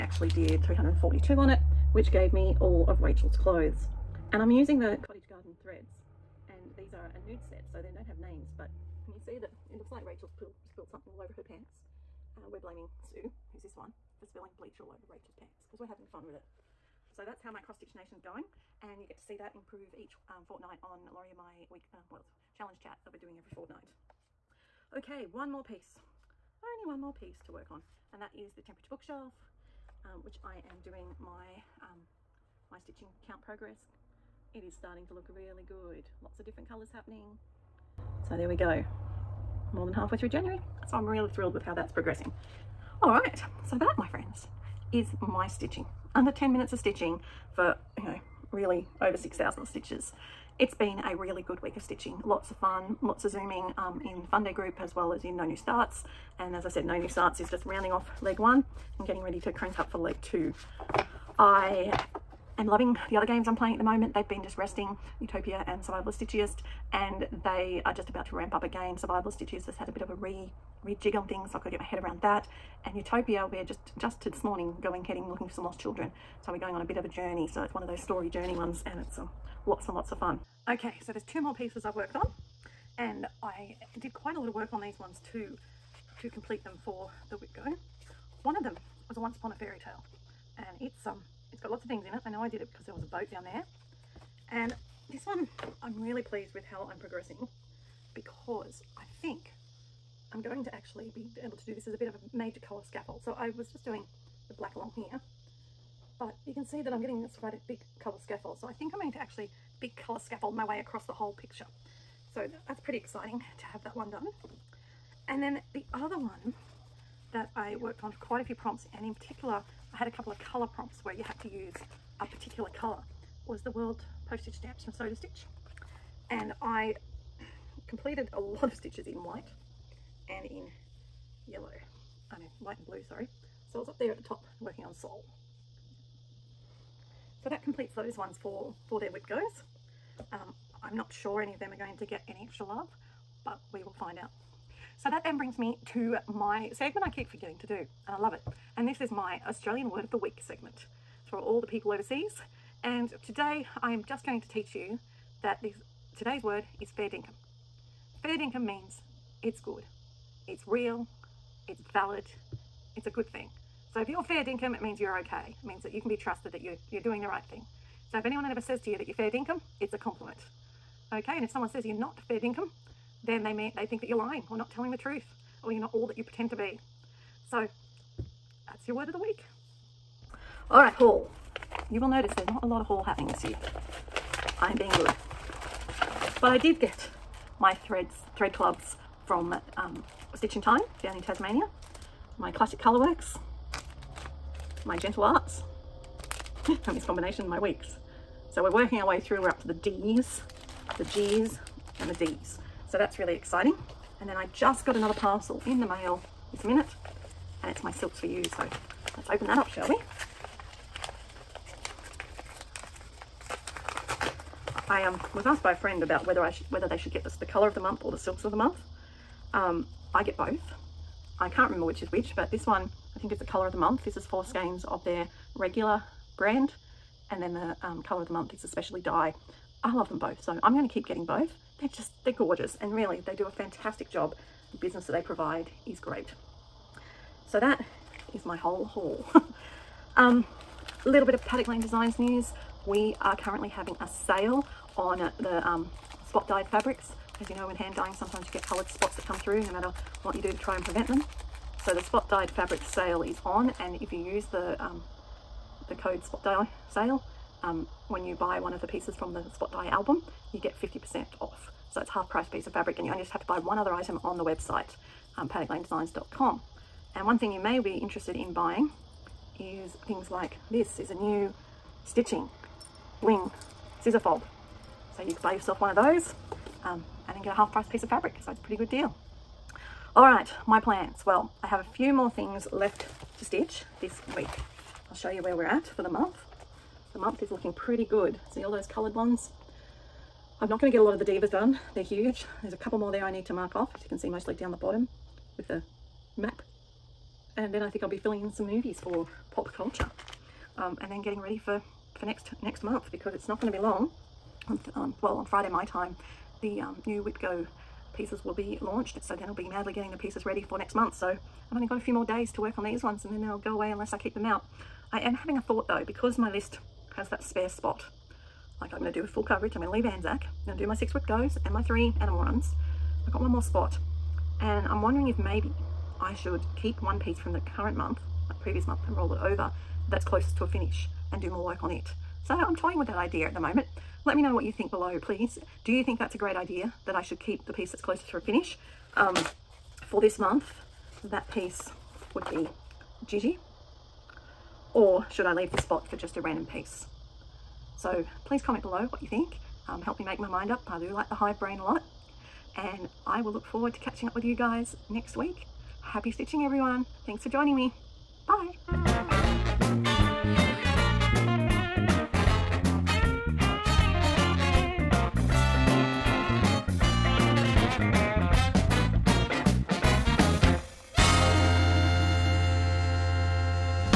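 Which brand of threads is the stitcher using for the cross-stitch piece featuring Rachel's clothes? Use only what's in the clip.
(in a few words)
Cottage Garden Threads.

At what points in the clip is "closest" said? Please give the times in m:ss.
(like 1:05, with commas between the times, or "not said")
5:30, 5:37.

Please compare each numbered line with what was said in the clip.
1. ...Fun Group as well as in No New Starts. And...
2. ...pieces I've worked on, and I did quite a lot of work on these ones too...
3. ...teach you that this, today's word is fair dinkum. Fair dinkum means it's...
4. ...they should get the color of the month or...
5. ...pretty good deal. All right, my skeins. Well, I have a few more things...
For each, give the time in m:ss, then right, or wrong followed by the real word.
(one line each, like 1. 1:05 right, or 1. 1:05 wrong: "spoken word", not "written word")
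1. 0:54 right
2. 1:21 right
3. 2:34 right
4. 3:36 right
5. 4:38 wrong: "plans", not "skeins".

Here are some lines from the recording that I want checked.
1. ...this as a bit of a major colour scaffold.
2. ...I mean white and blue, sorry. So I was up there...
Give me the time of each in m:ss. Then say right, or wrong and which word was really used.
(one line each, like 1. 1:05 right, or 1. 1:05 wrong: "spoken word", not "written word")
1. 1:41 right
2. 2:12 right.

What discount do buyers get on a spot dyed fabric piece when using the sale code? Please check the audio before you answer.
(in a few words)
50%.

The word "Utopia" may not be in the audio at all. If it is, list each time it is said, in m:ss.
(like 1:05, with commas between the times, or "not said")
1:05, 1:12.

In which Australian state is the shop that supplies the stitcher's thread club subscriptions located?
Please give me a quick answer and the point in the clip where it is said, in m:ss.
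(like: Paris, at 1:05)
Tasmania, at 3:11.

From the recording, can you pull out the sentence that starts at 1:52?
So that's pretty exciting to have that one done.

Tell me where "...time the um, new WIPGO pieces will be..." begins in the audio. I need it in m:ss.
5:05.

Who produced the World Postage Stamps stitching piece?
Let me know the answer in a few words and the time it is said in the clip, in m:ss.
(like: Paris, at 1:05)
Soda Stitch, at 2:04.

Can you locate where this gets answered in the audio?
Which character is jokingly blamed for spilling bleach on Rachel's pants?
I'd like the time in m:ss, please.
0:13.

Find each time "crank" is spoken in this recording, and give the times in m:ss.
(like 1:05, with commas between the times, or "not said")
0:59.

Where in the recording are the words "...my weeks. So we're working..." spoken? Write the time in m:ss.
3:17.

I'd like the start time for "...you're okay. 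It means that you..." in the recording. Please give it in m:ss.
2:44.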